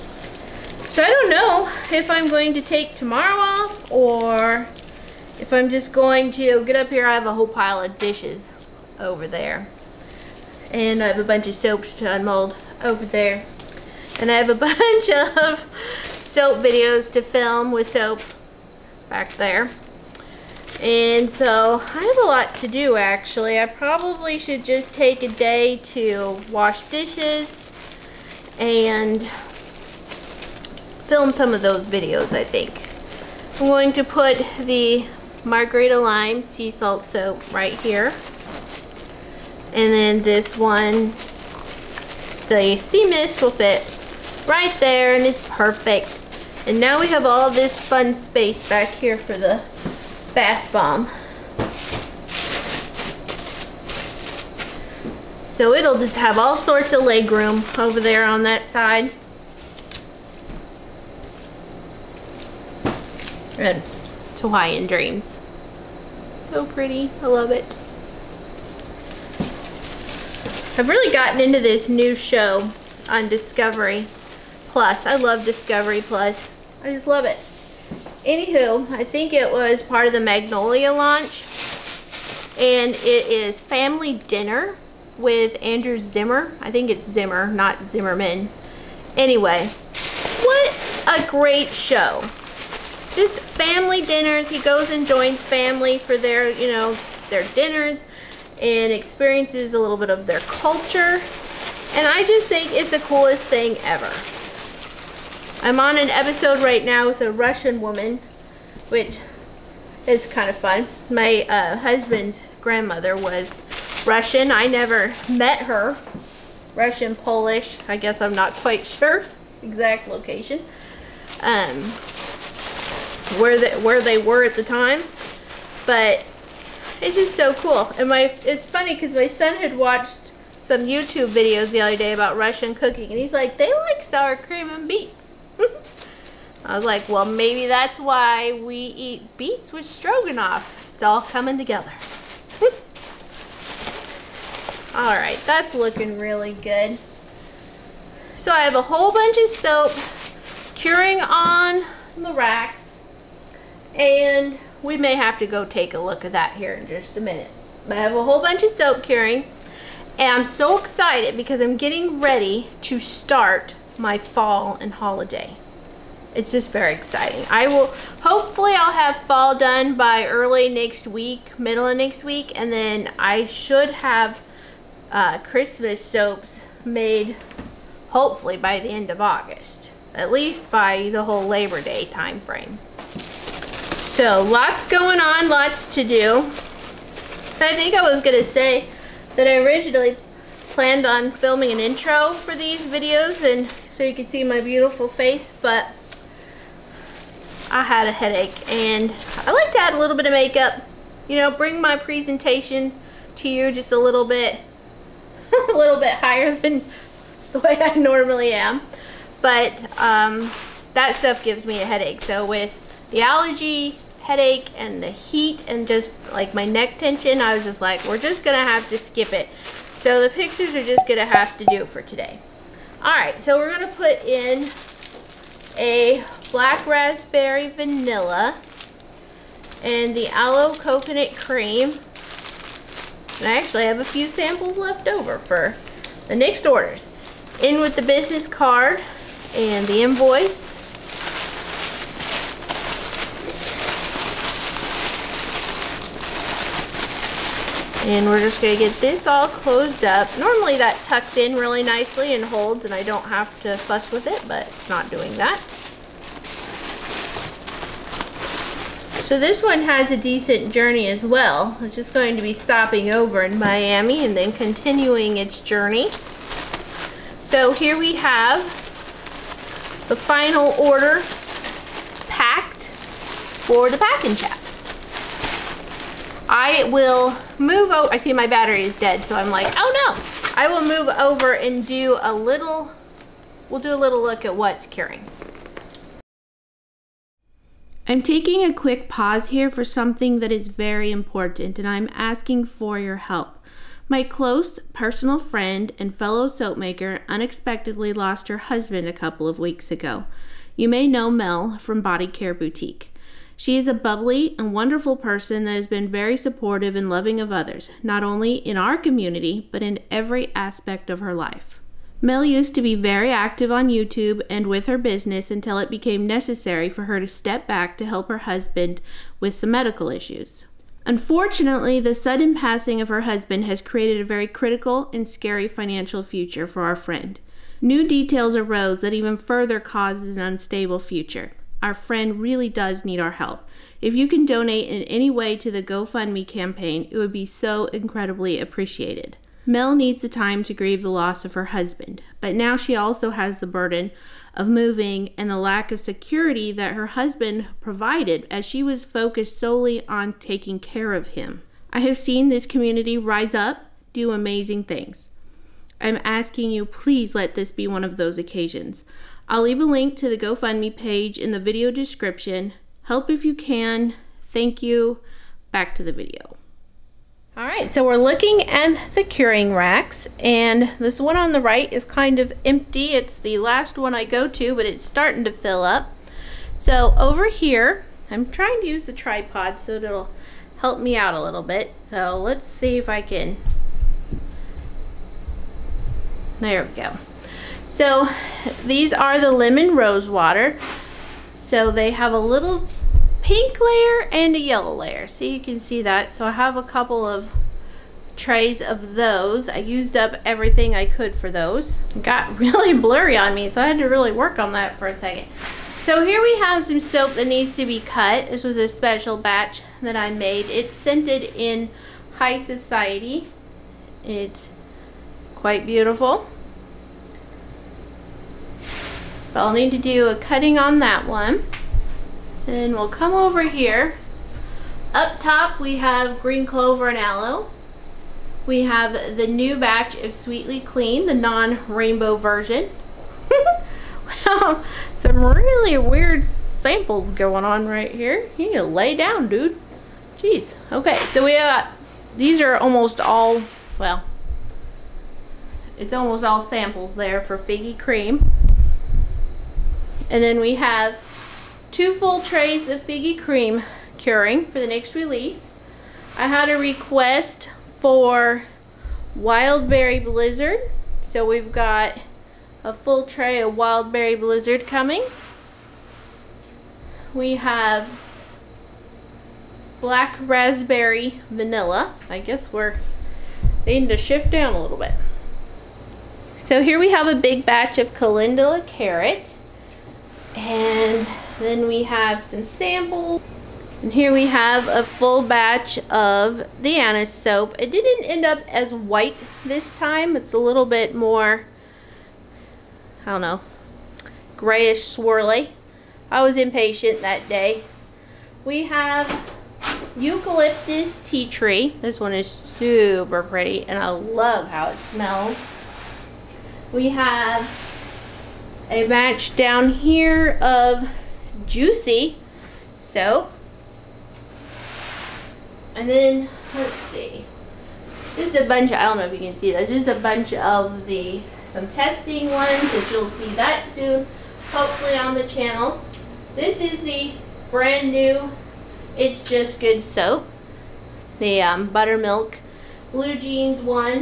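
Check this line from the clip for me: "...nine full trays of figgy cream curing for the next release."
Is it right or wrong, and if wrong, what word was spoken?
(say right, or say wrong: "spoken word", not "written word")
wrong: "two", not "nine".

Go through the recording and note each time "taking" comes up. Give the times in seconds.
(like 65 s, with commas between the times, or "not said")
288 s, 350 s.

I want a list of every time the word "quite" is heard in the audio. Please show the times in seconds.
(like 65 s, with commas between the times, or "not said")
118 s, 415 s.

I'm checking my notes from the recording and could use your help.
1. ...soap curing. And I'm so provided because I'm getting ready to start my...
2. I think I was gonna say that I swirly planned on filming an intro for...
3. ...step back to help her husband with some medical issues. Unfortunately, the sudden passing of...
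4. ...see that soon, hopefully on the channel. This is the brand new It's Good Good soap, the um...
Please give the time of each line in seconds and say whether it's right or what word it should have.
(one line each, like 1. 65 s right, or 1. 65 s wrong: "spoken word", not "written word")
1. 158 s wrong: "excited", not "provided"
2. 187 s wrong: "originally", not "swirly"
3. 317 s right
4. 523 s wrong: "Just", not "Good".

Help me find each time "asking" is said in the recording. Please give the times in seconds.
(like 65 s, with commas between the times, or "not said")
292 s, 356 s.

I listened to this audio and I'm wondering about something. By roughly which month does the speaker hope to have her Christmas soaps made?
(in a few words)
August.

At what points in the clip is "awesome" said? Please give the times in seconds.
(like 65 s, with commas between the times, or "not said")
not said.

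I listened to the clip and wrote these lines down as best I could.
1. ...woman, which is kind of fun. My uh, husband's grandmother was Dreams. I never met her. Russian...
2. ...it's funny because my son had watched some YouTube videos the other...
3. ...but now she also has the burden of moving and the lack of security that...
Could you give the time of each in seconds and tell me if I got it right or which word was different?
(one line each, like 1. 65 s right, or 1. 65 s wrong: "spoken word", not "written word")
1. 107 s wrong: "Russian", not "Dreams"
2. 128 s right
3. 342 s right.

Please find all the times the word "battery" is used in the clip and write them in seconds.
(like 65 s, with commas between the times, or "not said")
278 s.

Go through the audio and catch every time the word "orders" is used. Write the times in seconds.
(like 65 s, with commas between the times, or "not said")
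236 s, 270 s.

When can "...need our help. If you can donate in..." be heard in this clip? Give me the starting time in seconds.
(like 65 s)
333 s.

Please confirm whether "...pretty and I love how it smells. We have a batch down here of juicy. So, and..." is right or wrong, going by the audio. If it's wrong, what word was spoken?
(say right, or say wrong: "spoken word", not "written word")
right.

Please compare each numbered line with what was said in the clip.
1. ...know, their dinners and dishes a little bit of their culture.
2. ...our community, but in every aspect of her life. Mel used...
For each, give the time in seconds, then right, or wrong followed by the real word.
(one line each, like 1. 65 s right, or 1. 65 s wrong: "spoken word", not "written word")
1. 96 s wrong: "experiences", not "dishes"
2. 308 s right.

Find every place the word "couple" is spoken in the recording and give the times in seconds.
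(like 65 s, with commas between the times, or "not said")
299 s, 396 s.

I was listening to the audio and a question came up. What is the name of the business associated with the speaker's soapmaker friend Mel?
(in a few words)
Body Care Boutique.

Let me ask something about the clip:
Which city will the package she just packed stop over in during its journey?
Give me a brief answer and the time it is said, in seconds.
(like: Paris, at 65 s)
Miami, at 263 s.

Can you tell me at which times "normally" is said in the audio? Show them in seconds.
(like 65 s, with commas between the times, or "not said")
207 s, 250 s.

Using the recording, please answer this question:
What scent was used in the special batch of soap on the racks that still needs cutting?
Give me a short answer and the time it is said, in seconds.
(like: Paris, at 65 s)
High Society, at 412 s.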